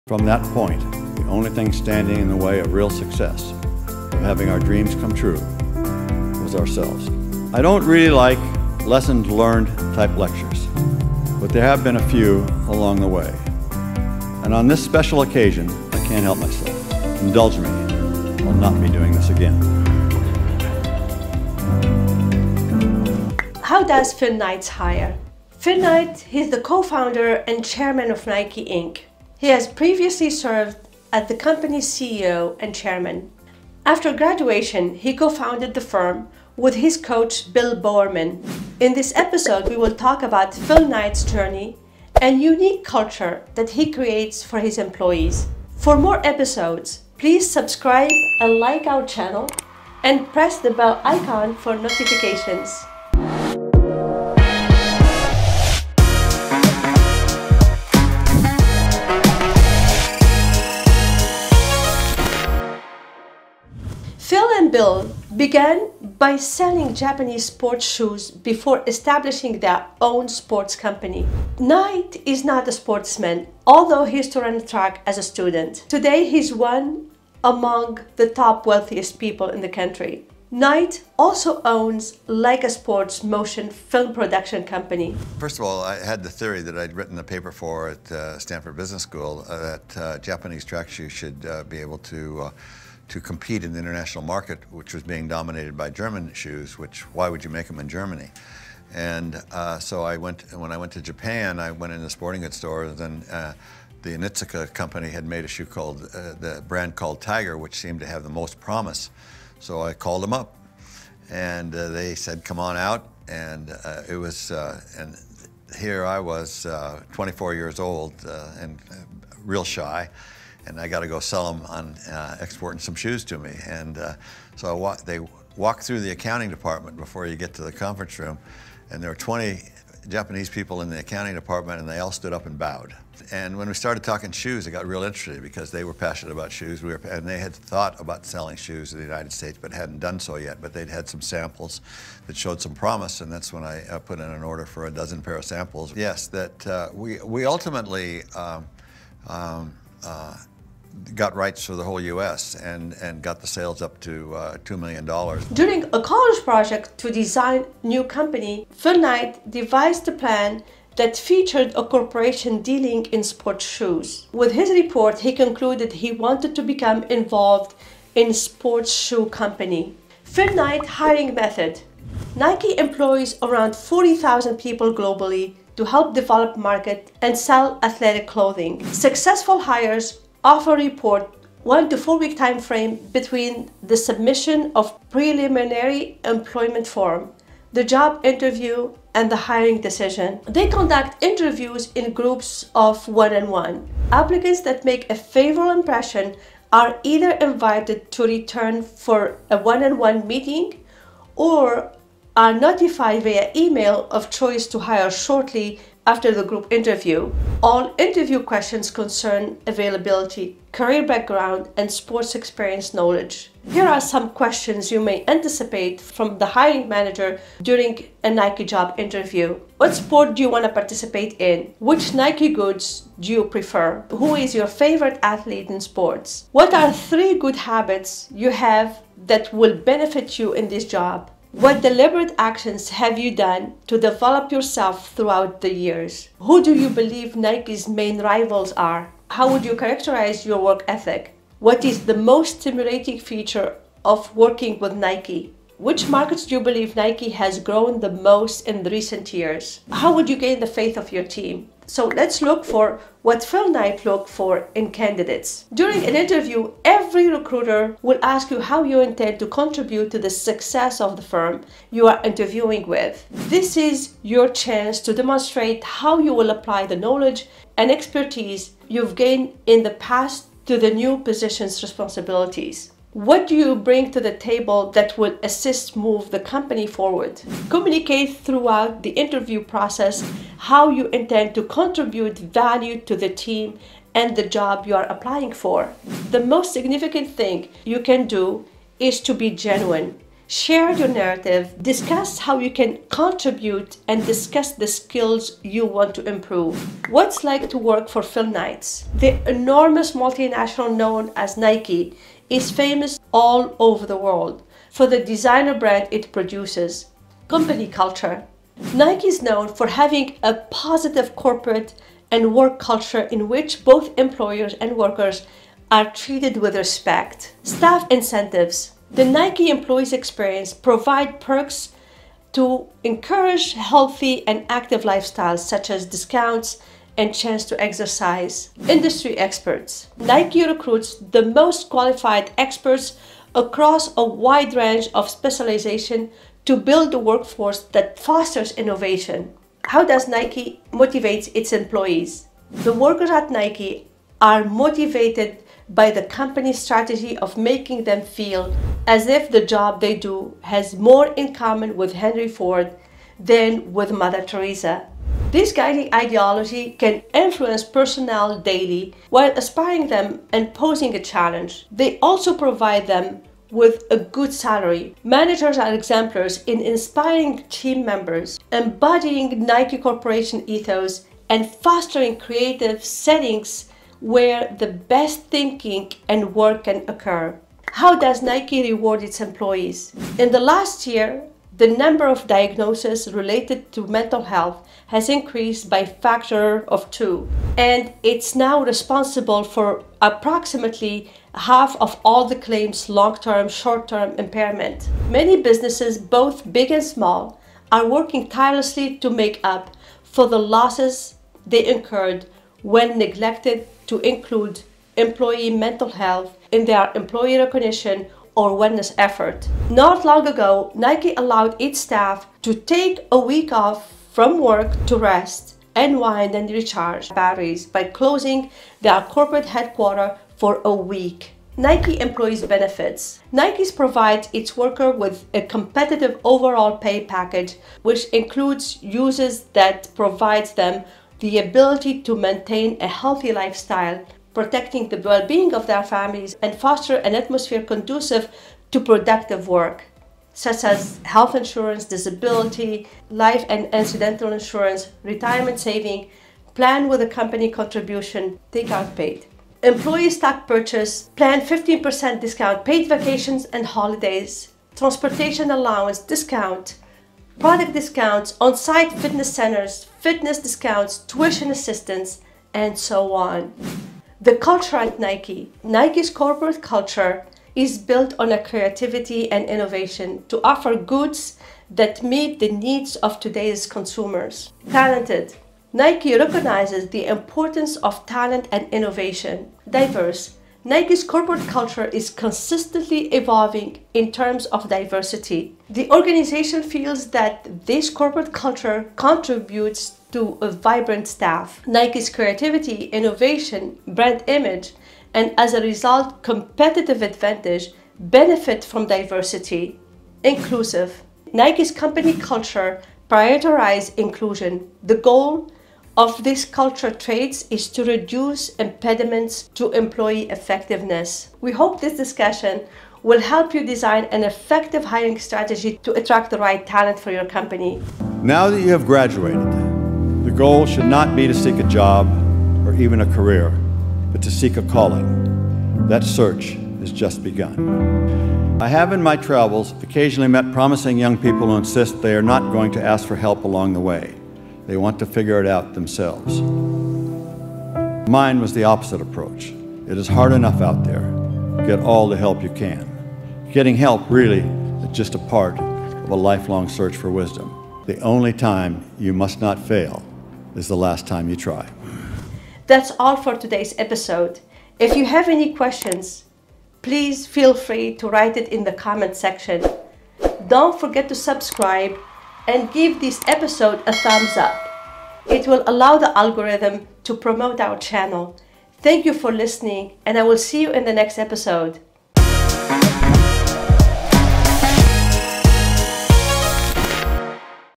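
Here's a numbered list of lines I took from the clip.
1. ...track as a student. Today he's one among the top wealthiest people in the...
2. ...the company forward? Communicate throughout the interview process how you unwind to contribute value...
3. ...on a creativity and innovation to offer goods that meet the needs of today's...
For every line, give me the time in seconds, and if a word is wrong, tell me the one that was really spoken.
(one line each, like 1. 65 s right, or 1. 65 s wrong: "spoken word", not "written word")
1. 74 s right
2. 276 s wrong: "intend", not "unwind"
3. 468 s right.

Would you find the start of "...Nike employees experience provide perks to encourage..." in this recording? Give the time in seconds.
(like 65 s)
319 s.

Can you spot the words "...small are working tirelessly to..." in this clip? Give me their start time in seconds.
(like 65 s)
397 s.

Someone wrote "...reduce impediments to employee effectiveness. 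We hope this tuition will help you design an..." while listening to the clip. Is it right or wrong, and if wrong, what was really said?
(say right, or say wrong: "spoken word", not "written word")
wrong: "discussion", not "tuition".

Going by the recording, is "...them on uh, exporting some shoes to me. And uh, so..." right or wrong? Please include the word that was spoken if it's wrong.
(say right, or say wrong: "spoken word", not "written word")
right.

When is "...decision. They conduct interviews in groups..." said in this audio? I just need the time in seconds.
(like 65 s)
189 s.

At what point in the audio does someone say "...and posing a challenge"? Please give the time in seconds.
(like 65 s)
360 s.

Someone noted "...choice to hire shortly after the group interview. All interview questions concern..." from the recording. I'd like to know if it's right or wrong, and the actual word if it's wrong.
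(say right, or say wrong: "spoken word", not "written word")
right.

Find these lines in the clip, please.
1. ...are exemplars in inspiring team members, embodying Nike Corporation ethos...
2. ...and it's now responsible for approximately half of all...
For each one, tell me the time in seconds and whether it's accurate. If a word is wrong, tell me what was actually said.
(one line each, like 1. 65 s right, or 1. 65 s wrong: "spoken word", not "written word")
1. 365 s right
2. 387 s right.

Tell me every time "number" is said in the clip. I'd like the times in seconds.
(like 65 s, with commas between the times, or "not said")
381 s.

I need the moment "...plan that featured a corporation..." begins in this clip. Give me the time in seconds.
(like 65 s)
160 s.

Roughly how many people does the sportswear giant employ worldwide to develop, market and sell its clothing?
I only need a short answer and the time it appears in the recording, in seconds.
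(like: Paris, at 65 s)
40,000, at 173 s.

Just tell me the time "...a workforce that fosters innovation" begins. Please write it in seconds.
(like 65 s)
337 s.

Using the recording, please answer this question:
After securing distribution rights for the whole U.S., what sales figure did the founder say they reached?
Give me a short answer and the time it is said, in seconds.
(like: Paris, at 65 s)
$2 million, at 154 s.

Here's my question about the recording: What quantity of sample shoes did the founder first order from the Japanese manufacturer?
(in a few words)
a dozen pair.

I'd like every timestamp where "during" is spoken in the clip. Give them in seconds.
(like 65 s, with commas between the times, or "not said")
155 s, 217 s, 255 s.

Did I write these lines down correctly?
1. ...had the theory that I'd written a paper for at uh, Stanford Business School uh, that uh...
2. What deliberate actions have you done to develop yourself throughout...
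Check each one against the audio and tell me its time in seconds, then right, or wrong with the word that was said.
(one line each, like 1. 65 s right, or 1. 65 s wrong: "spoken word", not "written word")
1. 85 s right
2. 231 s right.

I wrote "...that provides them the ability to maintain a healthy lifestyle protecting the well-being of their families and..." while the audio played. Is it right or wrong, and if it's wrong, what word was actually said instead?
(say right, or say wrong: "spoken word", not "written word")
right.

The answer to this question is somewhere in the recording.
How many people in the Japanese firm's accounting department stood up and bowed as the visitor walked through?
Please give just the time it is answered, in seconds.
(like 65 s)
129 s.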